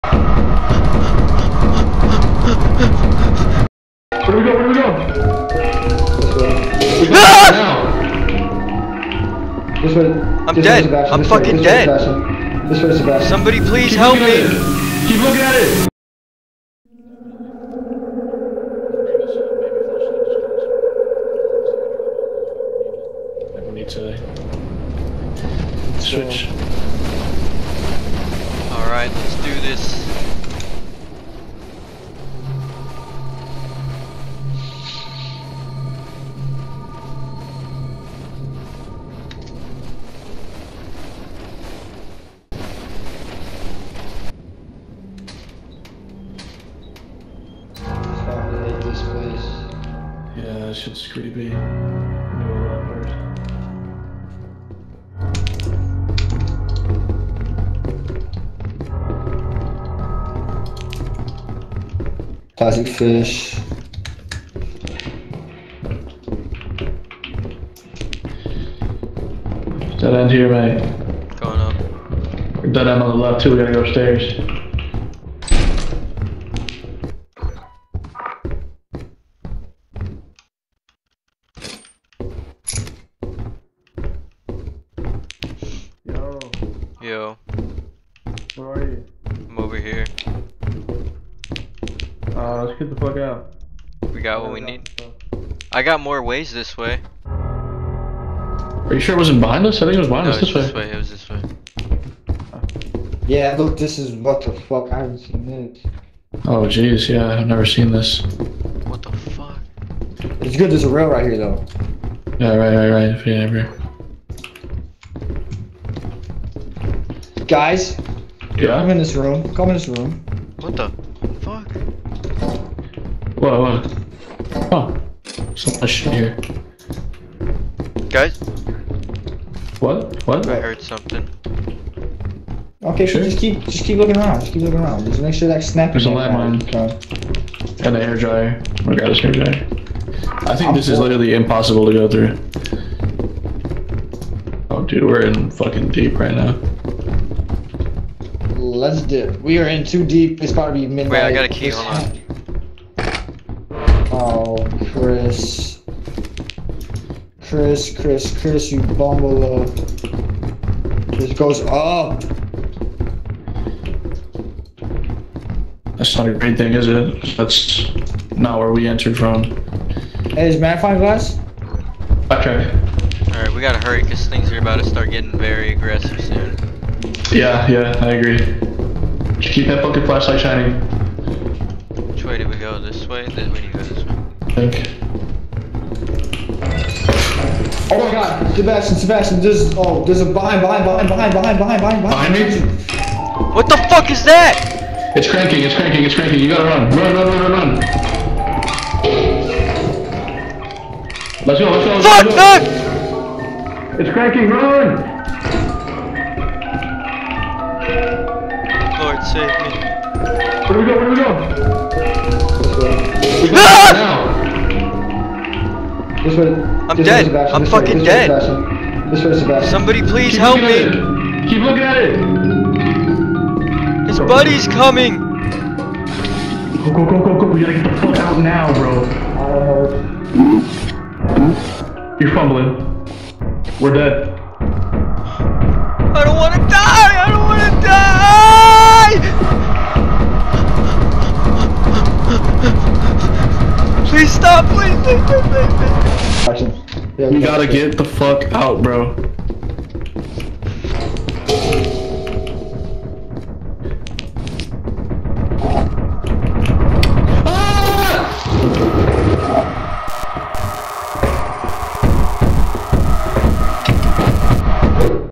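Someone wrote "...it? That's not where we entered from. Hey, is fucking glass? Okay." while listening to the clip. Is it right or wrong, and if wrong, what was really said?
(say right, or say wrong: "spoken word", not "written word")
wrong: "magnifying", not "fucking".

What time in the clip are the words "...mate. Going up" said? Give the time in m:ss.
1:10.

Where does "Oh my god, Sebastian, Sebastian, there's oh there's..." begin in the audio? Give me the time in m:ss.
3:07.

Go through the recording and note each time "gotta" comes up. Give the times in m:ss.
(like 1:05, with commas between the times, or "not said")
1:13, 2:53, 3:16, 3:47, 4:07.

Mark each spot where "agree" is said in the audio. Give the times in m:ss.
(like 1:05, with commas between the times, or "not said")
2:58.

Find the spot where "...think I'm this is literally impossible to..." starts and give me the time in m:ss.
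2:20.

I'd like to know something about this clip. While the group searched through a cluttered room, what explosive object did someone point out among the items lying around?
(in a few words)
Landmine.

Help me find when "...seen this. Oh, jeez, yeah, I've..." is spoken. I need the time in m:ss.
1:45.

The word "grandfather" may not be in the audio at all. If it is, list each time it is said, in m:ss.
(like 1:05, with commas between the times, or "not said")
not said.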